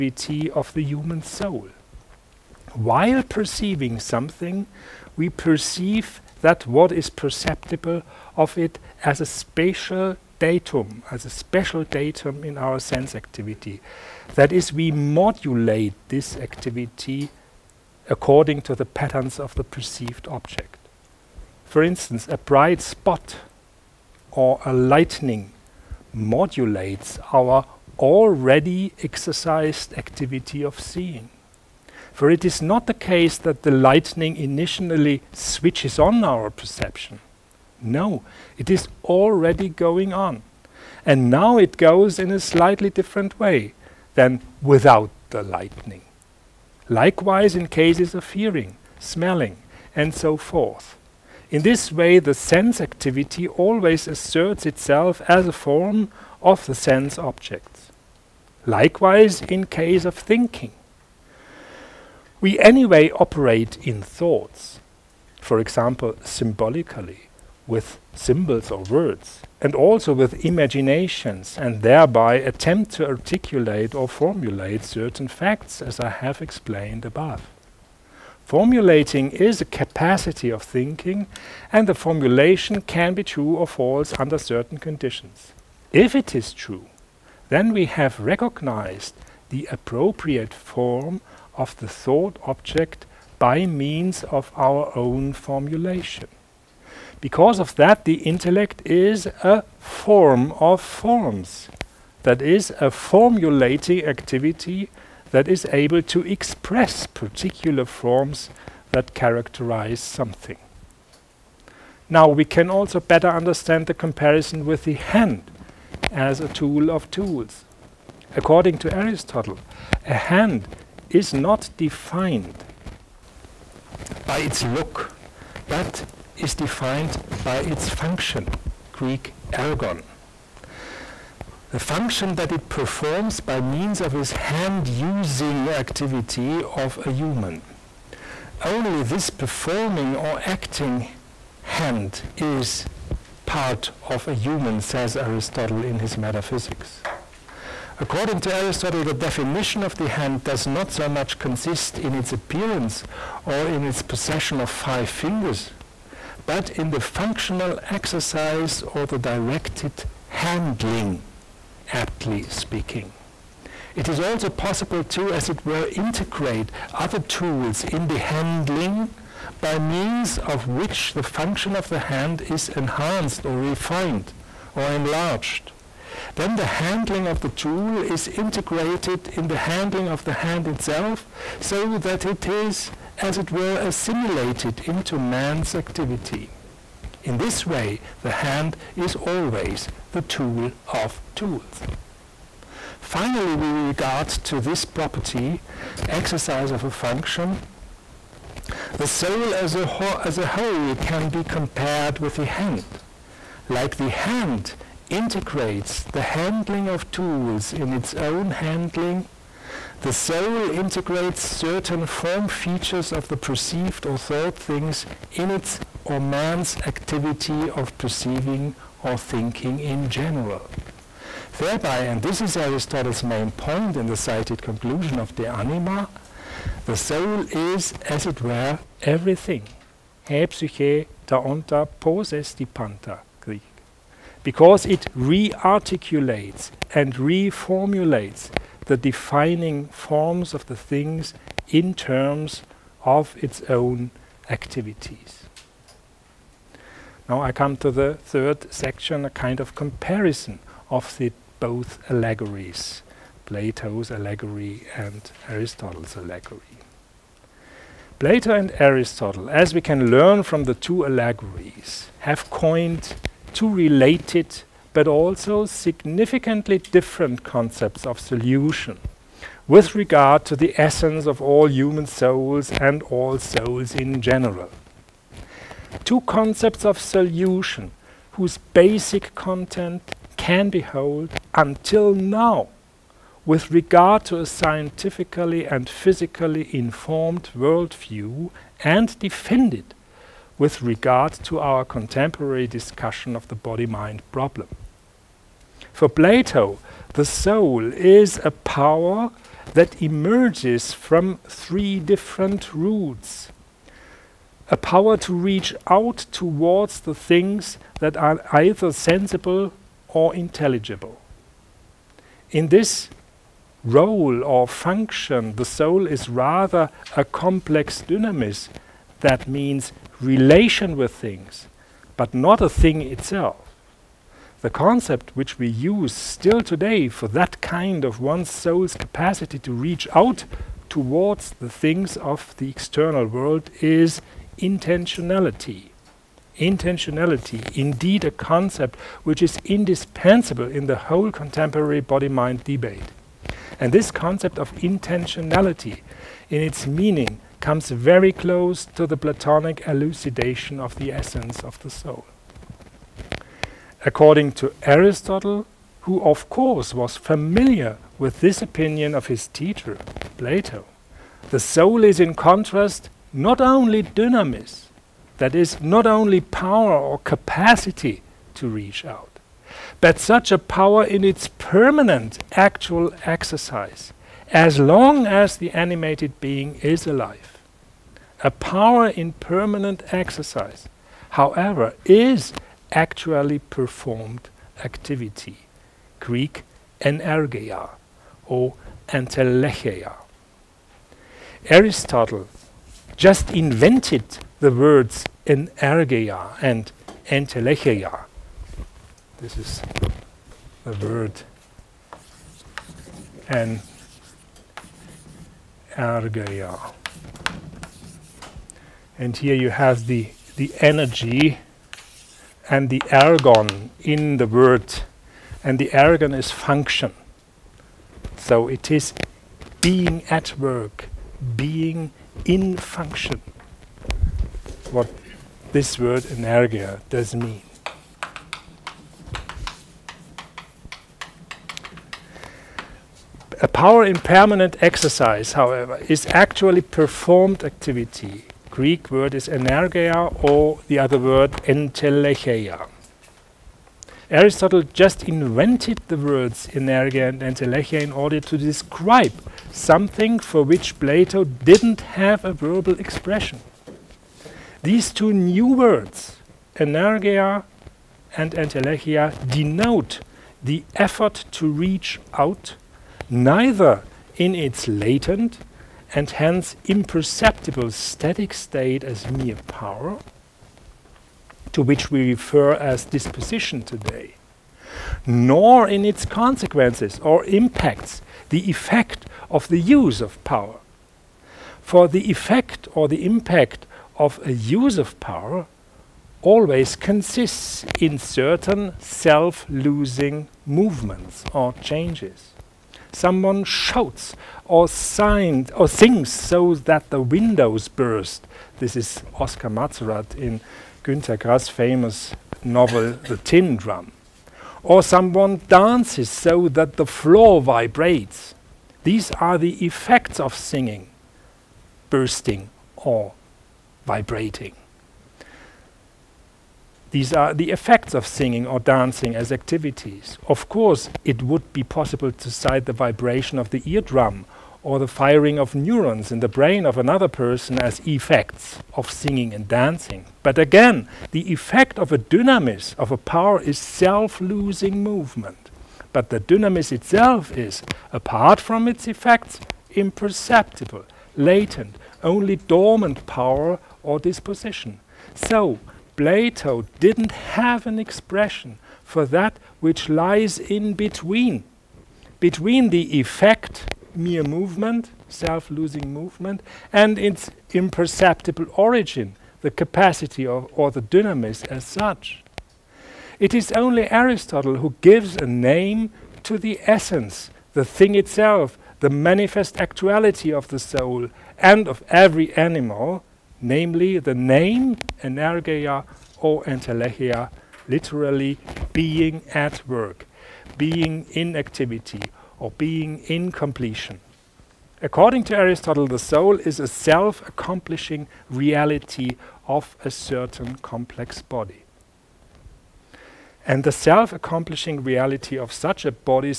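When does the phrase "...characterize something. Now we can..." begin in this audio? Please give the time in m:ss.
1:49.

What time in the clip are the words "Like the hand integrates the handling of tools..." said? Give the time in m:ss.
3:23.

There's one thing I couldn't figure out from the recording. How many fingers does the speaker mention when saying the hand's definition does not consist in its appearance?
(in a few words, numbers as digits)
5.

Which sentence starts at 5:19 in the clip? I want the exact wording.
That means relation with things, but not a thing itself.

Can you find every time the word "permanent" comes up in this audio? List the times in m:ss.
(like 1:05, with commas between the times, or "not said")
6:11, 6:19, 7:14.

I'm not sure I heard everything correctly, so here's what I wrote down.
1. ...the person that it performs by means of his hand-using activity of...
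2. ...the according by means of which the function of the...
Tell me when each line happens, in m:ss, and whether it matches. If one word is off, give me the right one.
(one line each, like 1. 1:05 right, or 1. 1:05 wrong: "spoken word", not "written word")
1. 2:11 wrong: "function", not "person"
2. 2:48 wrong: "handling", not "according".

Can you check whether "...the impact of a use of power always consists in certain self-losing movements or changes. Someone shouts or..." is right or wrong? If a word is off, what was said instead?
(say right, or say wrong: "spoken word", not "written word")
right.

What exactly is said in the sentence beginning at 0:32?
For it is not the case that the lightning initially switches on our perception.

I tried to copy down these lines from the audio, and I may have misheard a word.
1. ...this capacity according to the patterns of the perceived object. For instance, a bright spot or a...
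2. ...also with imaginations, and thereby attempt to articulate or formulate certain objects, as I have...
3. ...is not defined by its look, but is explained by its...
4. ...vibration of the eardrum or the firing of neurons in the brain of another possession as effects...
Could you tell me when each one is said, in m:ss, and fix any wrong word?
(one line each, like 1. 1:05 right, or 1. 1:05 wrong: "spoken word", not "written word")
1. 0:16 wrong: "activity", not "capacity"
2. 1:09 wrong: "facts", not "objects"
3. 2:01 wrong: "defined", not "explained"
4. 8:42 wrong: "person", not "possession".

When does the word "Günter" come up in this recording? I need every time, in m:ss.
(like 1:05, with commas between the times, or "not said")
8:21.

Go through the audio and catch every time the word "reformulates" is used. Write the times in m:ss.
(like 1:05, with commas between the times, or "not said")
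3:57.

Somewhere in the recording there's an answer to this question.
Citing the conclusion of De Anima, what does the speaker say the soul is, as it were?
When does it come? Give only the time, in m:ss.
3:49.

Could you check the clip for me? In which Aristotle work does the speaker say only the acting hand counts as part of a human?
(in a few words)
Metaphysics.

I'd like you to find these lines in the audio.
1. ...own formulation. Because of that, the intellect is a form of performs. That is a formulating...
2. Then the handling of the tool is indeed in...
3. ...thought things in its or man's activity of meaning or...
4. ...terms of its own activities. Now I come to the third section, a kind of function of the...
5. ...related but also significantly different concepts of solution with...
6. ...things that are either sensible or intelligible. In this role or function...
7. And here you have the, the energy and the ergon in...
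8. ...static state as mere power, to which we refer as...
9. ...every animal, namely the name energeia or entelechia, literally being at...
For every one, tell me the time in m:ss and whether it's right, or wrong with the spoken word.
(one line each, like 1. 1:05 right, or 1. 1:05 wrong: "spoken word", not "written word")
1. 1:34 wrong: "forms", not "performs"
2. 2:56 wrong: "integrated", not "indeed"
3. 3:34 wrong: "perceiving", not "meaning"
4. 4:01 wrong: "comparison", not "function"
5. 4:23 right
6. 5:07 right
7. 6:49 right
8. 7:47 right
9. 9:32 right.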